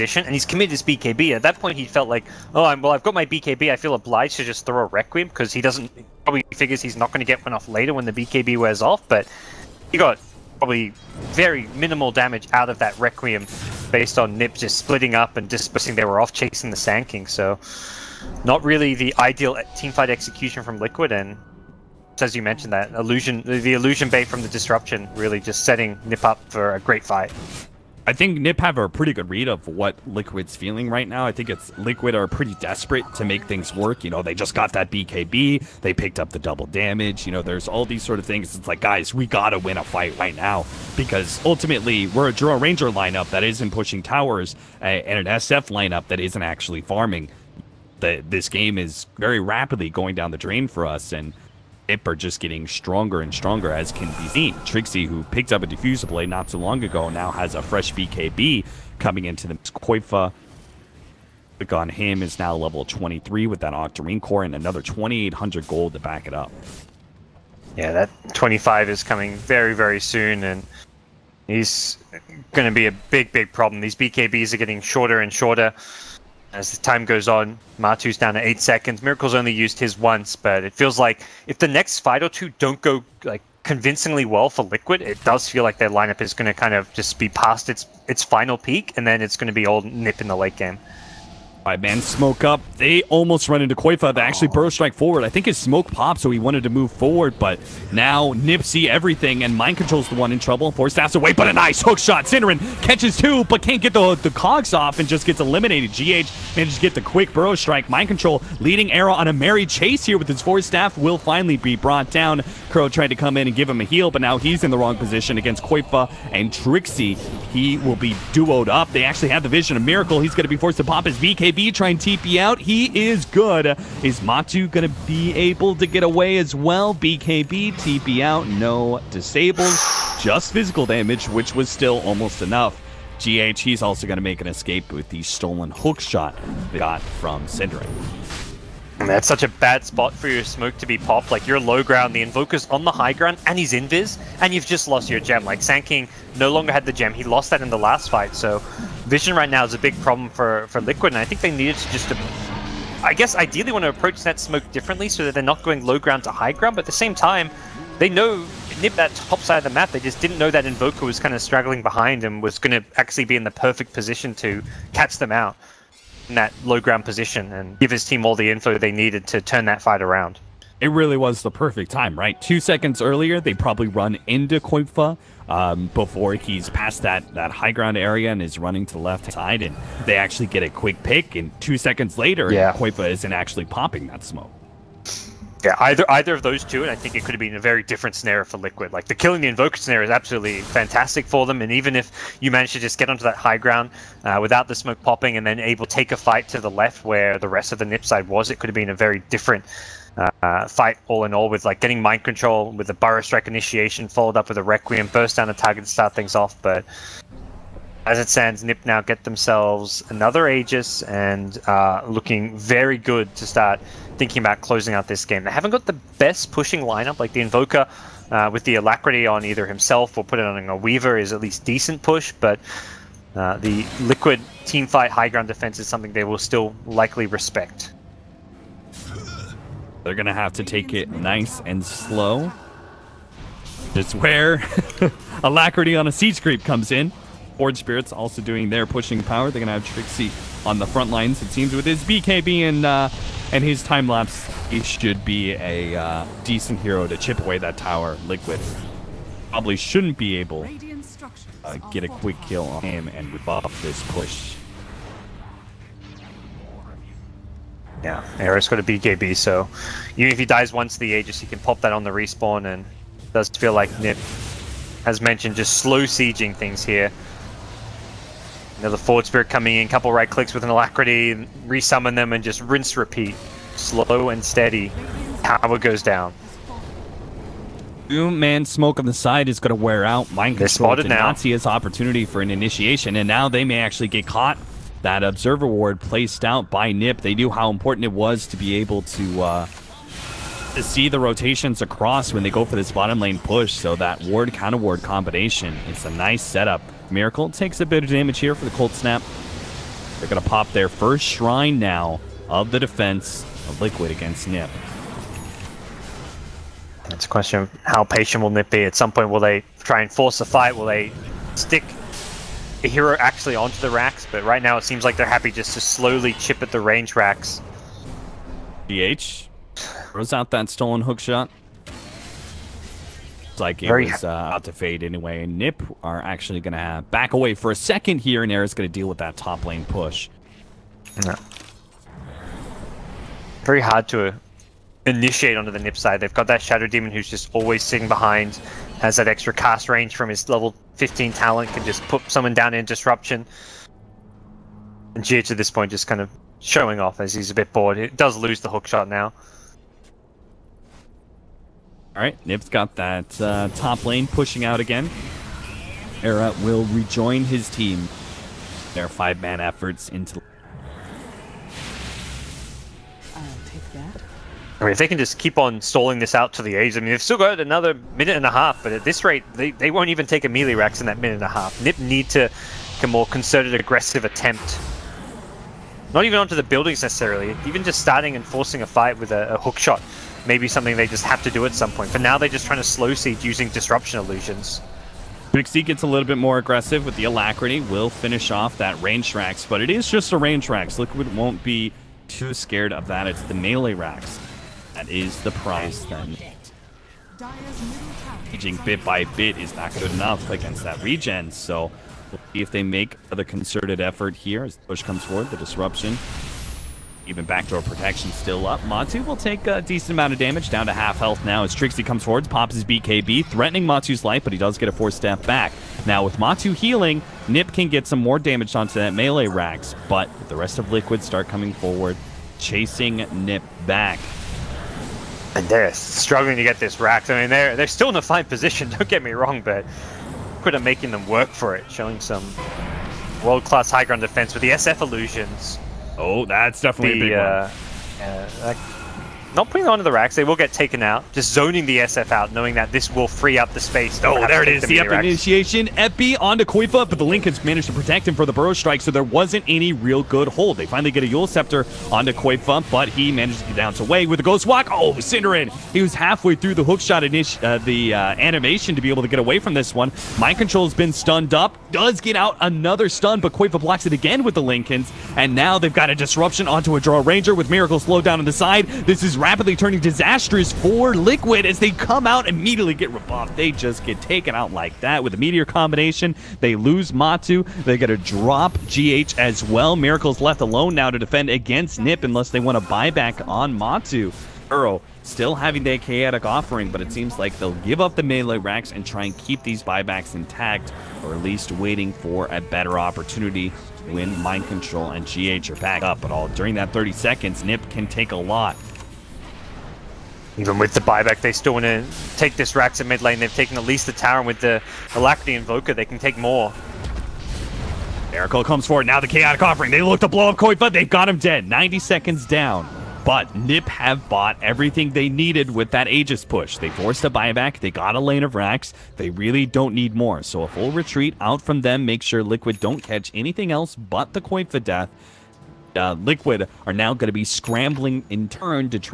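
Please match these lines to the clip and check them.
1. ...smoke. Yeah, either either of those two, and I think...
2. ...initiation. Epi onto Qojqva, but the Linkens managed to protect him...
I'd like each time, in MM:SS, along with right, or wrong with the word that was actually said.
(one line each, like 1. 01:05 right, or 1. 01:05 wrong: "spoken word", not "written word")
1. 03:04 right
2. 07:25 right.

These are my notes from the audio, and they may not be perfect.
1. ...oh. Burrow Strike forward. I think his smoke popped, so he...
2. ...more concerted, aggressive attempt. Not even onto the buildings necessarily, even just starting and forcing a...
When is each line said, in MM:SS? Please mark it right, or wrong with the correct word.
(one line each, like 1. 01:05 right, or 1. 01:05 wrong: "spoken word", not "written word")
1. 01:34 right
2. 06:13 right.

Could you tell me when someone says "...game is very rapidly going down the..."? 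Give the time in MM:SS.
00:48.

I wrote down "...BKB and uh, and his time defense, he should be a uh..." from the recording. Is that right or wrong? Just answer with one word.
wrong.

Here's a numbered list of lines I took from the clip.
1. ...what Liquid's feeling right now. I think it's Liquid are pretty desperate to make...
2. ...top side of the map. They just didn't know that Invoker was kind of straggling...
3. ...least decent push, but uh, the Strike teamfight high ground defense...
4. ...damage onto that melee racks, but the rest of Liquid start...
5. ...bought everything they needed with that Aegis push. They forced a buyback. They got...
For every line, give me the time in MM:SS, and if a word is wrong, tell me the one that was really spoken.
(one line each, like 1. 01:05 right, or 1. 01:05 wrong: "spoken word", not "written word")
1. 00:29 right
2. 02:39 right
3. 03:41 wrong: "Liquid", not "Strike"
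4. 06:58 right
5. 08:34 right.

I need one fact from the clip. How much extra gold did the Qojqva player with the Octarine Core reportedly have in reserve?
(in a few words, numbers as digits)
2,800.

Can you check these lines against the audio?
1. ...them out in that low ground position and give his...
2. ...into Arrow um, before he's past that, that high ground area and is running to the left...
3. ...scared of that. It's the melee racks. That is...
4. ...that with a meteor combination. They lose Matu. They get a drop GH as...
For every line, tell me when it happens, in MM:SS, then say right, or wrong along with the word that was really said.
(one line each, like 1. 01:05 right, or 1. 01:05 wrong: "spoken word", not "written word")
1. 02:45 right
2. 02:54 wrong: "Qojqva", not "Arrow"
3. 06:32 right
4. 07:54 right.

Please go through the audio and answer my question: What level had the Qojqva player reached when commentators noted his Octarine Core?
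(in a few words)
23.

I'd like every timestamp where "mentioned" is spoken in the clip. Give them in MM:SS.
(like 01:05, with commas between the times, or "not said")
00:22, 04:25.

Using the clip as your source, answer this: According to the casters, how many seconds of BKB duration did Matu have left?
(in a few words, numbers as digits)
8.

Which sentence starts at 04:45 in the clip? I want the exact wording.
That Observer Ward placed out by Nip.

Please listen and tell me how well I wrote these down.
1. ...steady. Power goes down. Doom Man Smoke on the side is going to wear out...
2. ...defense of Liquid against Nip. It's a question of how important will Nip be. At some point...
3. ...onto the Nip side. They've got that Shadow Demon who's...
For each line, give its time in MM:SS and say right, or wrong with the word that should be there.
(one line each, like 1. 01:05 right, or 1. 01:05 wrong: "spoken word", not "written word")
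1. 04:34 right
2. 05:02 wrong: "patient", not "important"
3. 05:35 right.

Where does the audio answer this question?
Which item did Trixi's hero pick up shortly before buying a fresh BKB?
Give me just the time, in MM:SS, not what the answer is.
00:55.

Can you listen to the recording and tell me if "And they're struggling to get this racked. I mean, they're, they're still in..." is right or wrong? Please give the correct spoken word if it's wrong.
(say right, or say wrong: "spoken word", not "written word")
right.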